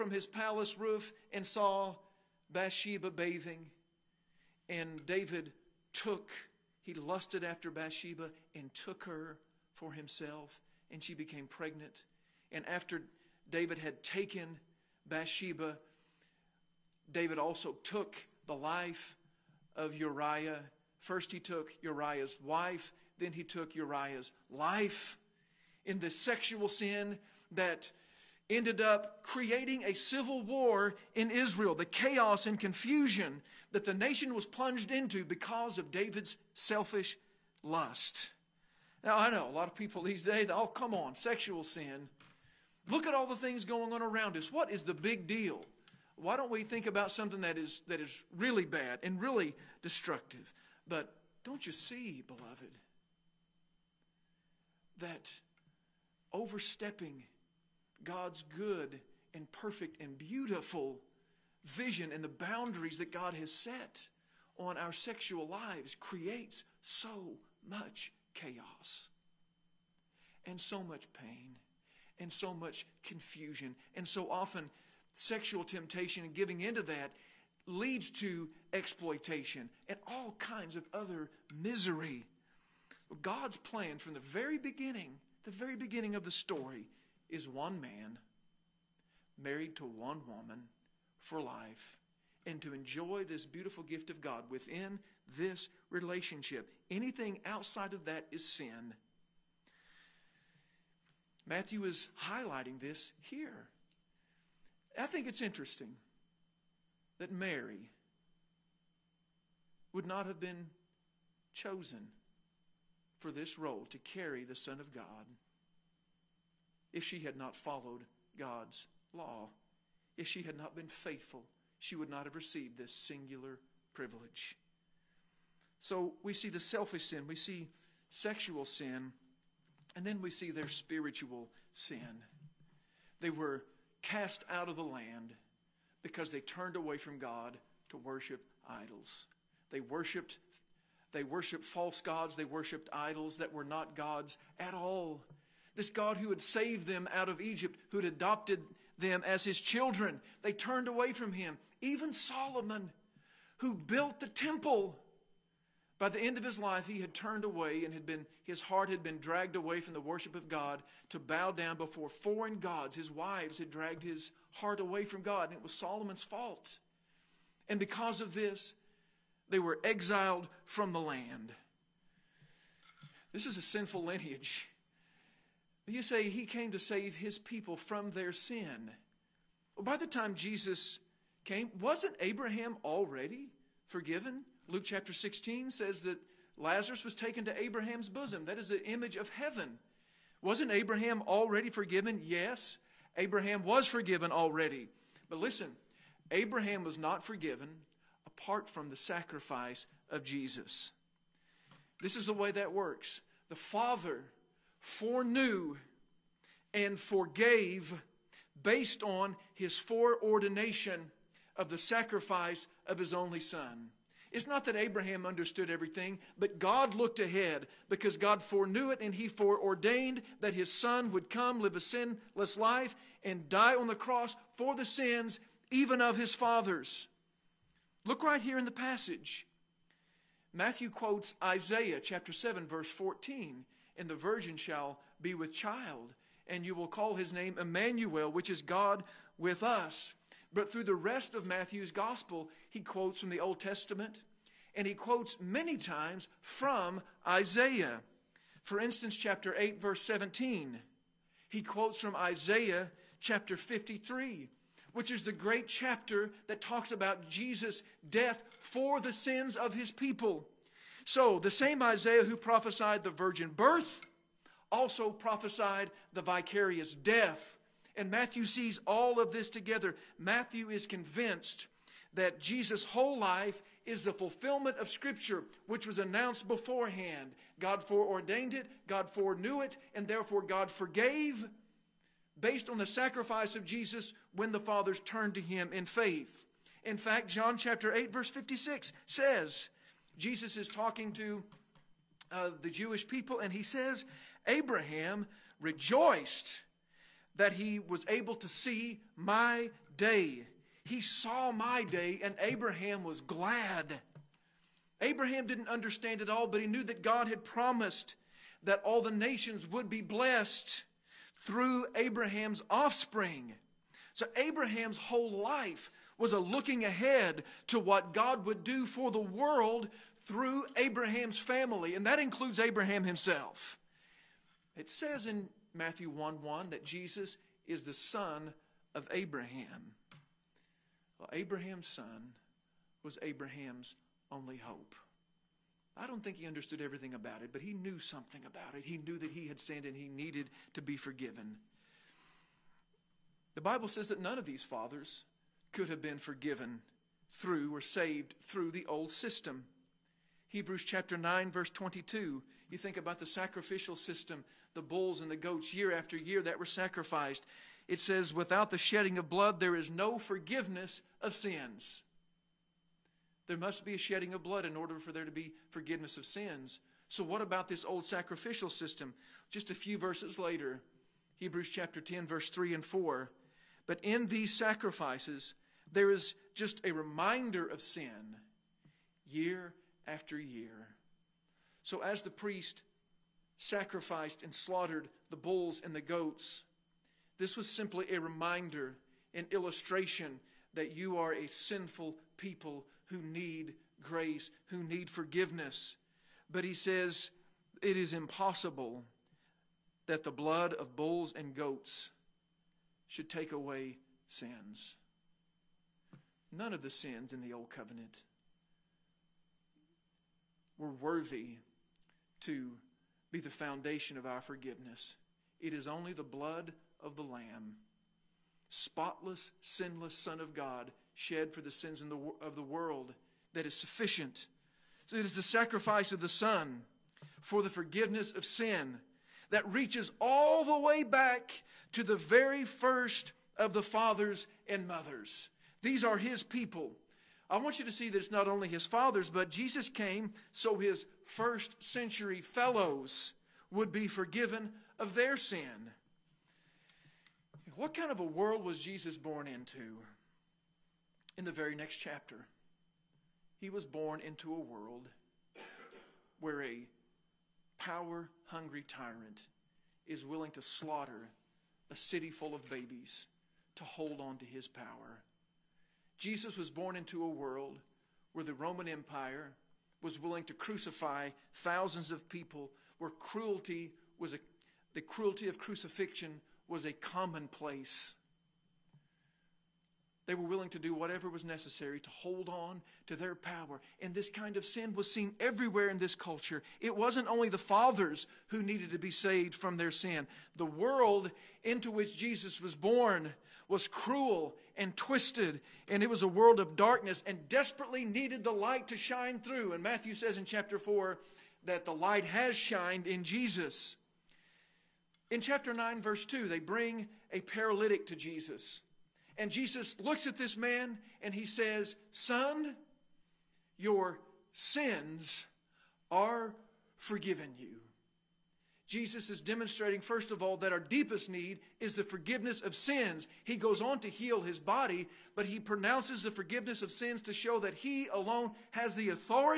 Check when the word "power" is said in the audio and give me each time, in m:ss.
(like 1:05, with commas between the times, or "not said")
7:37, 7:44, 8:03.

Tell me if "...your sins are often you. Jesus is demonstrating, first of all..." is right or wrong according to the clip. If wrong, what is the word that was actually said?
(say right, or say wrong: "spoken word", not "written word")
wrong: "forgiven", not "often".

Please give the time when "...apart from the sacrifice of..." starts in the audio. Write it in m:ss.
3:18.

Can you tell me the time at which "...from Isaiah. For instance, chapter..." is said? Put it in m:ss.
4:06.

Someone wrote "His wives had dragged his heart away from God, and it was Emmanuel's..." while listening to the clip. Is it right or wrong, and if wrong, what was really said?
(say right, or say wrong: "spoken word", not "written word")
wrong: "Solomon", not "Emmanuel".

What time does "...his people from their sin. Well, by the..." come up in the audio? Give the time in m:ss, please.
2:57.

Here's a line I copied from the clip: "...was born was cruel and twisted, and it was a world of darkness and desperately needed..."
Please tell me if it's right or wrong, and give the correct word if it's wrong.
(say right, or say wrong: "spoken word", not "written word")
right.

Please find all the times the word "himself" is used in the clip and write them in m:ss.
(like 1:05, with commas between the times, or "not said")
0:09, 5:23.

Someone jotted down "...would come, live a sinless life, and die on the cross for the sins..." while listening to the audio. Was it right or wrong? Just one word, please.
right.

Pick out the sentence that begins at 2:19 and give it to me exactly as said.
They worshiped they worshiped false gods.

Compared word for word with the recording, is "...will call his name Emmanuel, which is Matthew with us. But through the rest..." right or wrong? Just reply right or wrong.
wrong.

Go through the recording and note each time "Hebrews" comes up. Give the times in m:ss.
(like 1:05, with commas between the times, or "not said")
5:50, 6:11.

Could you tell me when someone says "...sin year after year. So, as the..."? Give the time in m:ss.
6:17.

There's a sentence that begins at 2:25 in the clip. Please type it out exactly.
This God who had saved them out of Egypt, who had adopted them as his children, they turned away from him.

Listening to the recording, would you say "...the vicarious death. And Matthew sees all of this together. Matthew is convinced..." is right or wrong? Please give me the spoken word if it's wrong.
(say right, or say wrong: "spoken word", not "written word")
right.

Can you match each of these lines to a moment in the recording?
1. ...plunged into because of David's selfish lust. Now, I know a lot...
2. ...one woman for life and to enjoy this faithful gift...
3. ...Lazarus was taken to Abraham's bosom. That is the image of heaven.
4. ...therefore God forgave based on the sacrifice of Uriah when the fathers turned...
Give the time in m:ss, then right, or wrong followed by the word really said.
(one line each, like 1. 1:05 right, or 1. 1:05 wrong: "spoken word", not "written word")
1. 0:34 right
2. 1:29 wrong: "beautiful", not "faithful"
3. 3:06 right
4. 4:40 wrong: "Jesus", not "Uriah".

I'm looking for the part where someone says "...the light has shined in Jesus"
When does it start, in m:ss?
8:21.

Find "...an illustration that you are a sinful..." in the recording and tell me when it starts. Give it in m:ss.
6:29.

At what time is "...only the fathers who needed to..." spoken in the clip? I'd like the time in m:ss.
8:07.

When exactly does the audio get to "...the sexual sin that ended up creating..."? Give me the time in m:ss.
0:25.